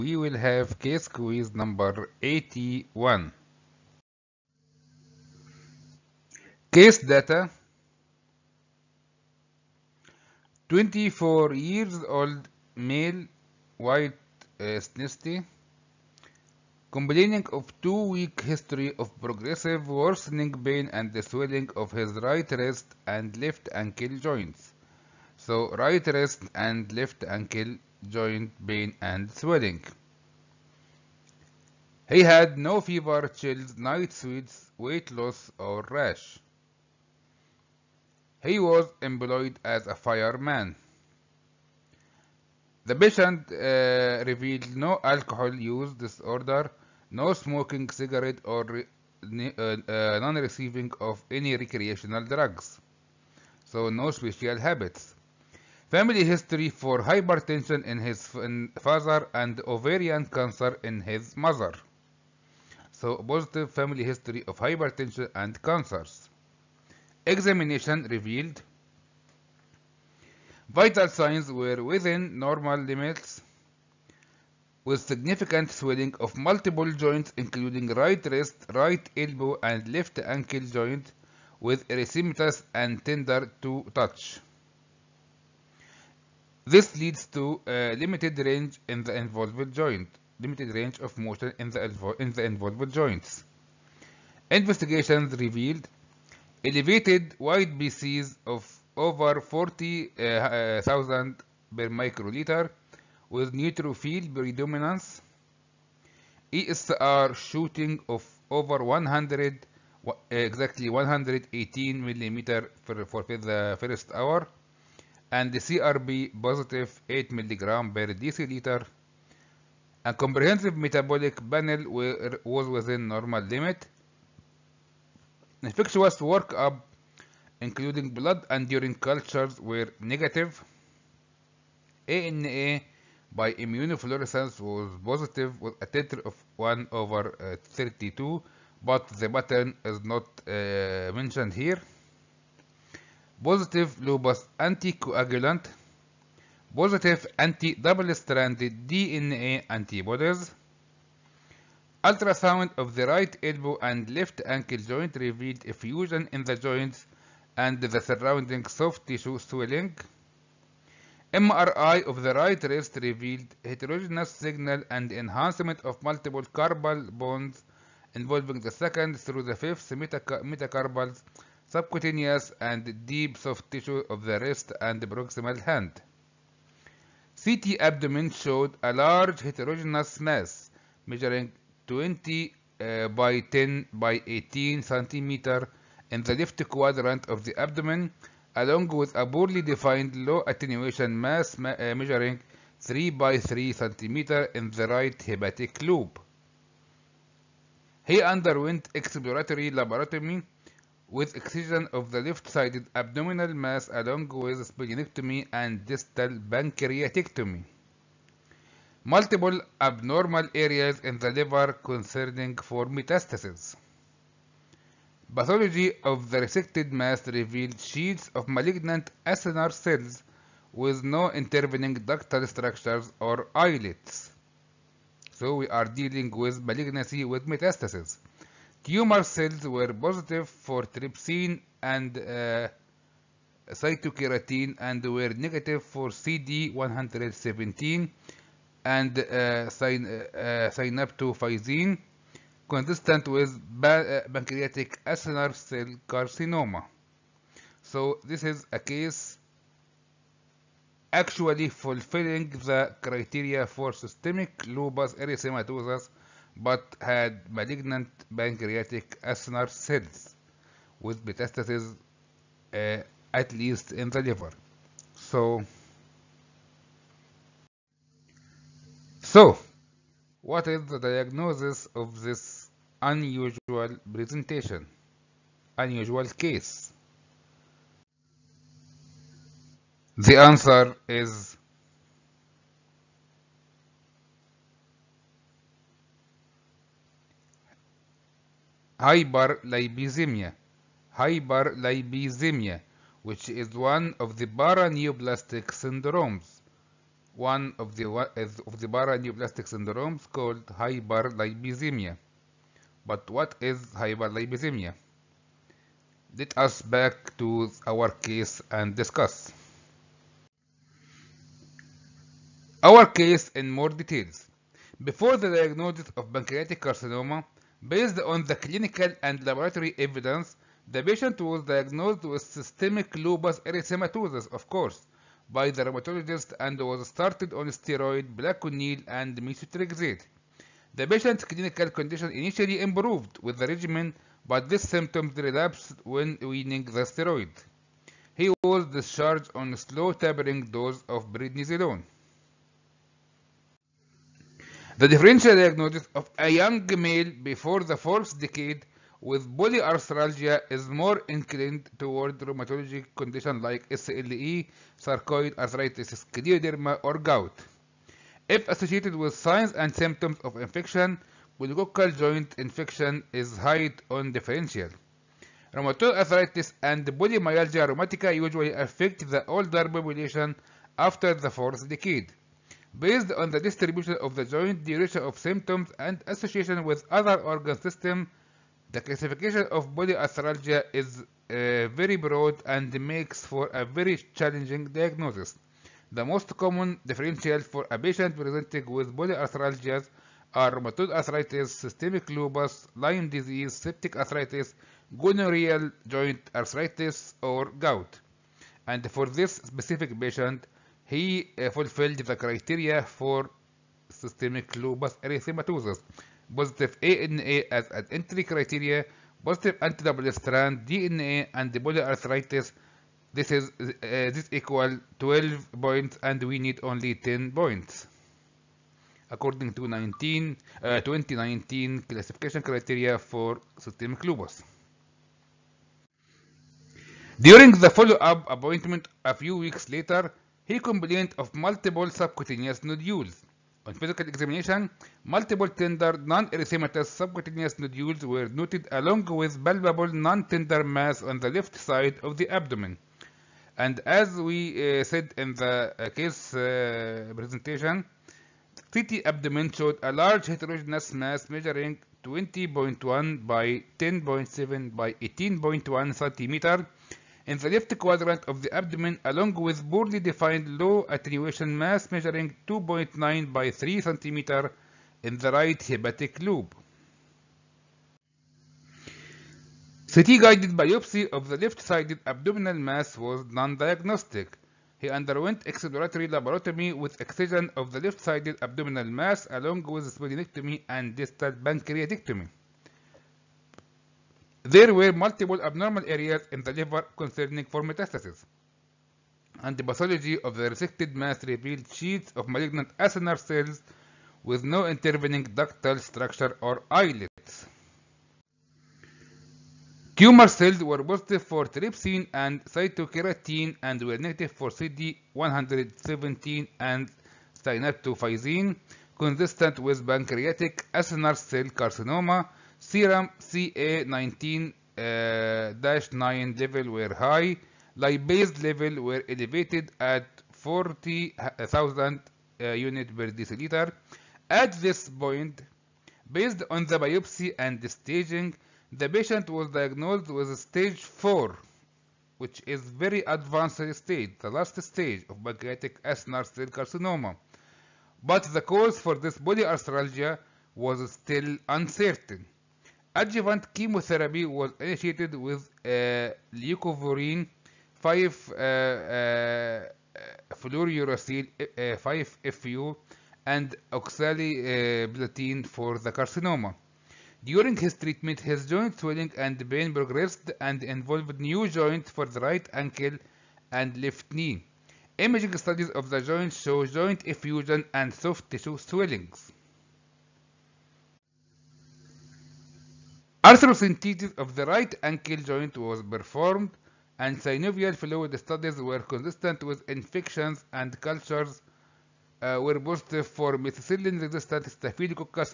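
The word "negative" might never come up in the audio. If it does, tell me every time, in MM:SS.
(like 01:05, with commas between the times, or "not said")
02:09, 03:55, 08:24.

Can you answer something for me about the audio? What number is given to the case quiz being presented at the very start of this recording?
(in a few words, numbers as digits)
81.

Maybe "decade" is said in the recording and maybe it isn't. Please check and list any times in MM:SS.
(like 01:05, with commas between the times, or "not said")
05:48, 06:11.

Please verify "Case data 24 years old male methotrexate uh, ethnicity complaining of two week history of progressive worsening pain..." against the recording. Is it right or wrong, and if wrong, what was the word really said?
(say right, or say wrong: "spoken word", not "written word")
wrong: "white", not "methotrexate".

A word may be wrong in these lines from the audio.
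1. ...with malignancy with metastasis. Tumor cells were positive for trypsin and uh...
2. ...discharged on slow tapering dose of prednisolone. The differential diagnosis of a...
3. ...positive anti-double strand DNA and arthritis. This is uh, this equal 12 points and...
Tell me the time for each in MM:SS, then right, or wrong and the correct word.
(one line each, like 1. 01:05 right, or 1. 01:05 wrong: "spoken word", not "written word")
1. 03:46 right
2. 05:38 right
3. 06:49 right.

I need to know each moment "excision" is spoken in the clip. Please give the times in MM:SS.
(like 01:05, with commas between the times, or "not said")
03:21, 07:57.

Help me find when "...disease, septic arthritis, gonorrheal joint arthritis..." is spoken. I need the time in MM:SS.
06:33.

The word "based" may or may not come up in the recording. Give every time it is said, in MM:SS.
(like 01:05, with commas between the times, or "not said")
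05:17, 06:12, 08:46.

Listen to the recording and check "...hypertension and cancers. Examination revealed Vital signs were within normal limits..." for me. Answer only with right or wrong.
right.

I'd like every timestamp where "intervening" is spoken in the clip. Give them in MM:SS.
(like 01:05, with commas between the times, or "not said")
03:41, 08:14.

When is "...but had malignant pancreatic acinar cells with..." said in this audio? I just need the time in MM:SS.
04:16.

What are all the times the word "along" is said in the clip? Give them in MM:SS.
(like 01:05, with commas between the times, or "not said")
03:08, 03:24, 07:18, 07:39, 07:59.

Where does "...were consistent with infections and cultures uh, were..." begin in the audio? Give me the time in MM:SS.
09:38.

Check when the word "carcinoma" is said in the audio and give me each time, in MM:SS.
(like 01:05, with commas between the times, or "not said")
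04:06, 05:16, 08:31, 08:56, 09:16.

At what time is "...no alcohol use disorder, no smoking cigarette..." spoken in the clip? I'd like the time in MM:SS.
00:44.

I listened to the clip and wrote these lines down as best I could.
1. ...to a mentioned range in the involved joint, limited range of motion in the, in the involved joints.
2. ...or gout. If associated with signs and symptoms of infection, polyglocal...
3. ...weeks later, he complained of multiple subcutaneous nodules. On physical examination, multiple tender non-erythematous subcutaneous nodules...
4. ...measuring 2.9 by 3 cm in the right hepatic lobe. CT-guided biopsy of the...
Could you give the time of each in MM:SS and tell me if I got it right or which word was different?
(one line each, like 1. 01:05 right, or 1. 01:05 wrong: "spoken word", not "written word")
1. 01:27 wrong: "limited", not "mentioned"
2. 05:57 right
3. 07:09 right
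4. 07:42 right.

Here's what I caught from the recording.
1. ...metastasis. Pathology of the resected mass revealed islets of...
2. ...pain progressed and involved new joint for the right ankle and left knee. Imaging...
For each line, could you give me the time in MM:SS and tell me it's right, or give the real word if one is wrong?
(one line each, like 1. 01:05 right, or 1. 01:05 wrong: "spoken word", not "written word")
1. 03:32 wrong: "sheets", not "islets"
2. 09:19 right.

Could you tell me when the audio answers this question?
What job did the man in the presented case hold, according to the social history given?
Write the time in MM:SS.
00:39.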